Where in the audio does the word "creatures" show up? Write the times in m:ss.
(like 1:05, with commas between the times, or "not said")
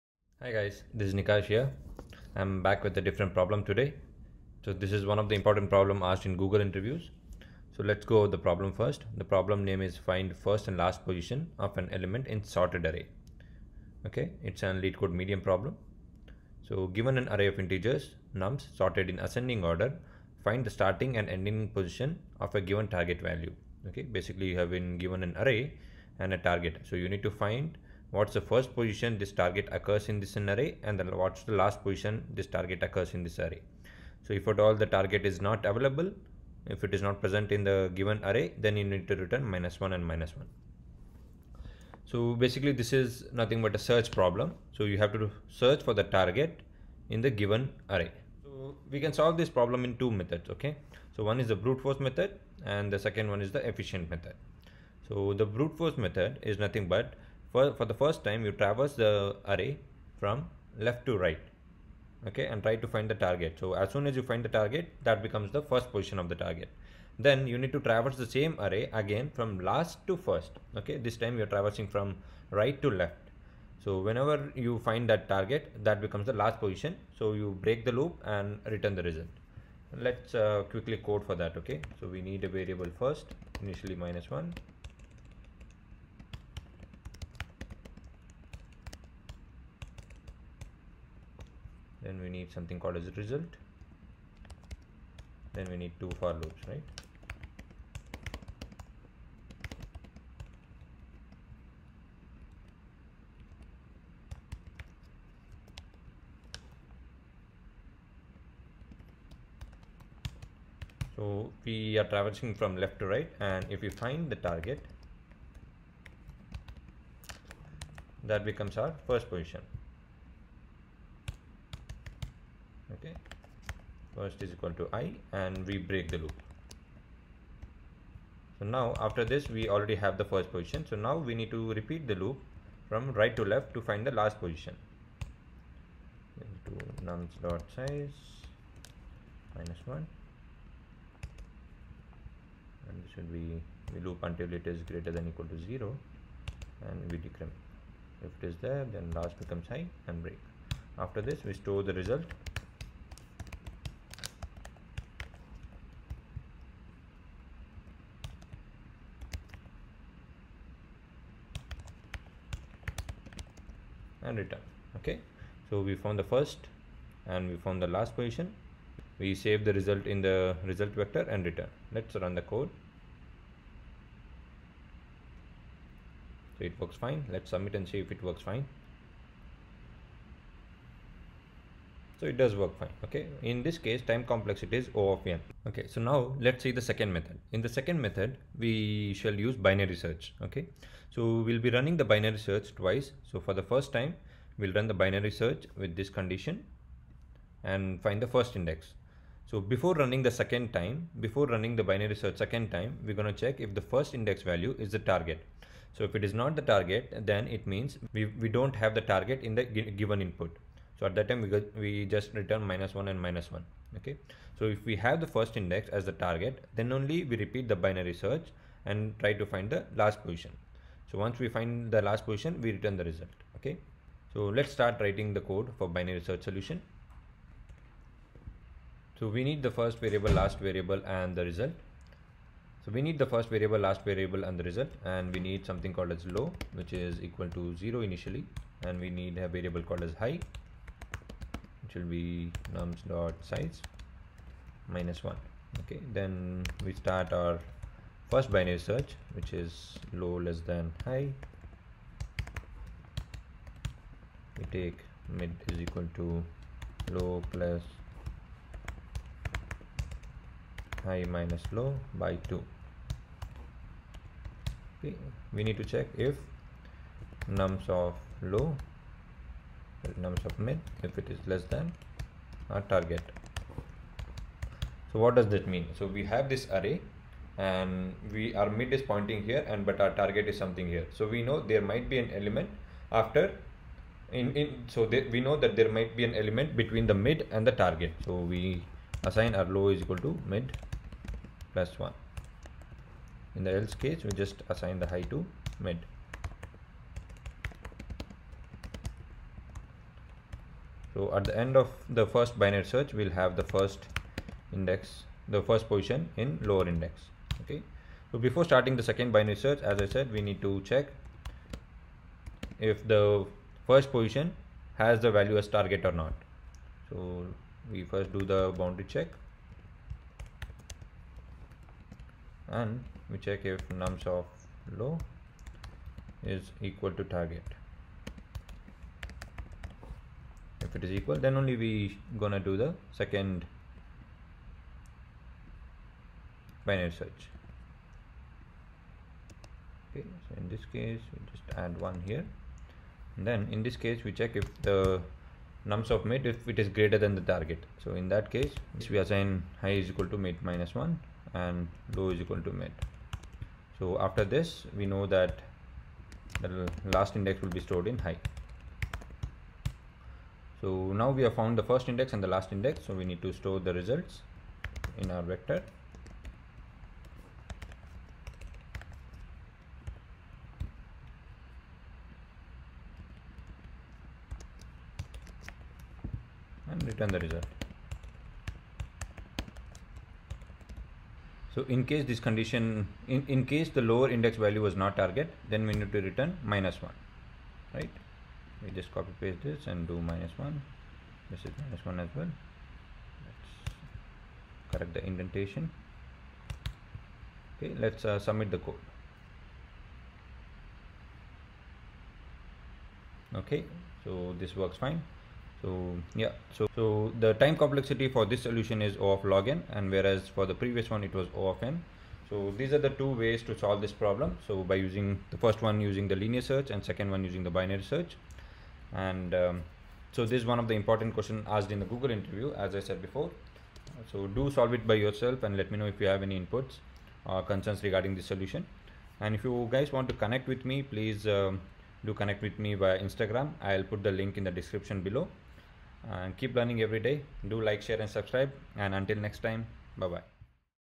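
not said.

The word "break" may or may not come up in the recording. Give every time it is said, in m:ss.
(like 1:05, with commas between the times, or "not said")
1:17, 2:05, 2:30.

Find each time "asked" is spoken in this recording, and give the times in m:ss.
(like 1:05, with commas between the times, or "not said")
0:06, 7:01.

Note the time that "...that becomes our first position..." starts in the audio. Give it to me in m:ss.
1:58.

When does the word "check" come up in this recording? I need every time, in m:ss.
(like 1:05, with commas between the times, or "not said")
3:23, 4:25, 5:10, 5:19, 5:23, 5:44.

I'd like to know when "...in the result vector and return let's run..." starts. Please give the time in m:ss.
2:50.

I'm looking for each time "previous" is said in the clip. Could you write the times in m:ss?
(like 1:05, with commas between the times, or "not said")
6:50.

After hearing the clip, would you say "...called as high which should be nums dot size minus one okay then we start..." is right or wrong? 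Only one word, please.
right.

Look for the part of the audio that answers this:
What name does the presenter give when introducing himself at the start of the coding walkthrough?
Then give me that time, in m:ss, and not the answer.
0:01.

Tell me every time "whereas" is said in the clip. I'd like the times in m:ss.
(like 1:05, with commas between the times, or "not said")
6:50.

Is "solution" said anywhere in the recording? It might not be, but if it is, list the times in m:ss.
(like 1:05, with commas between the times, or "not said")
3:46, 6:48, 7:08.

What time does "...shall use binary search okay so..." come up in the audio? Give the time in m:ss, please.
3:09.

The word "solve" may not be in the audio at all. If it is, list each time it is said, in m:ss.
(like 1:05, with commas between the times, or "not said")
0:49, 6:53, 7:04.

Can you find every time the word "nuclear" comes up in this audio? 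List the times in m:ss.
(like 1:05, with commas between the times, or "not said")
not said.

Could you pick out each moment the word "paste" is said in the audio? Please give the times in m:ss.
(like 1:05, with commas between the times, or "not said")
6:29.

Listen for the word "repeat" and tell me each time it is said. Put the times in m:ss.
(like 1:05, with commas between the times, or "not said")
2:11, 3:37.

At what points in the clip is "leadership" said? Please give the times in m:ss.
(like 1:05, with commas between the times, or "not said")
not said.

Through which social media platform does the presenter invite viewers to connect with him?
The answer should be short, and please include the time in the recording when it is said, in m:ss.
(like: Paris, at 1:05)
Instagram, at 7:13.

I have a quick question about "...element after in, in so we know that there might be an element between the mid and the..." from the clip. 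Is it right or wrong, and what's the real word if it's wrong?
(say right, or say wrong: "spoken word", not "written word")
right.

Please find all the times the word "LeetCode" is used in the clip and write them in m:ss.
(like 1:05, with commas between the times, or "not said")
0:14.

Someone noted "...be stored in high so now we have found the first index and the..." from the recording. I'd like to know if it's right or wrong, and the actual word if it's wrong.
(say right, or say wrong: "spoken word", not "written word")
right.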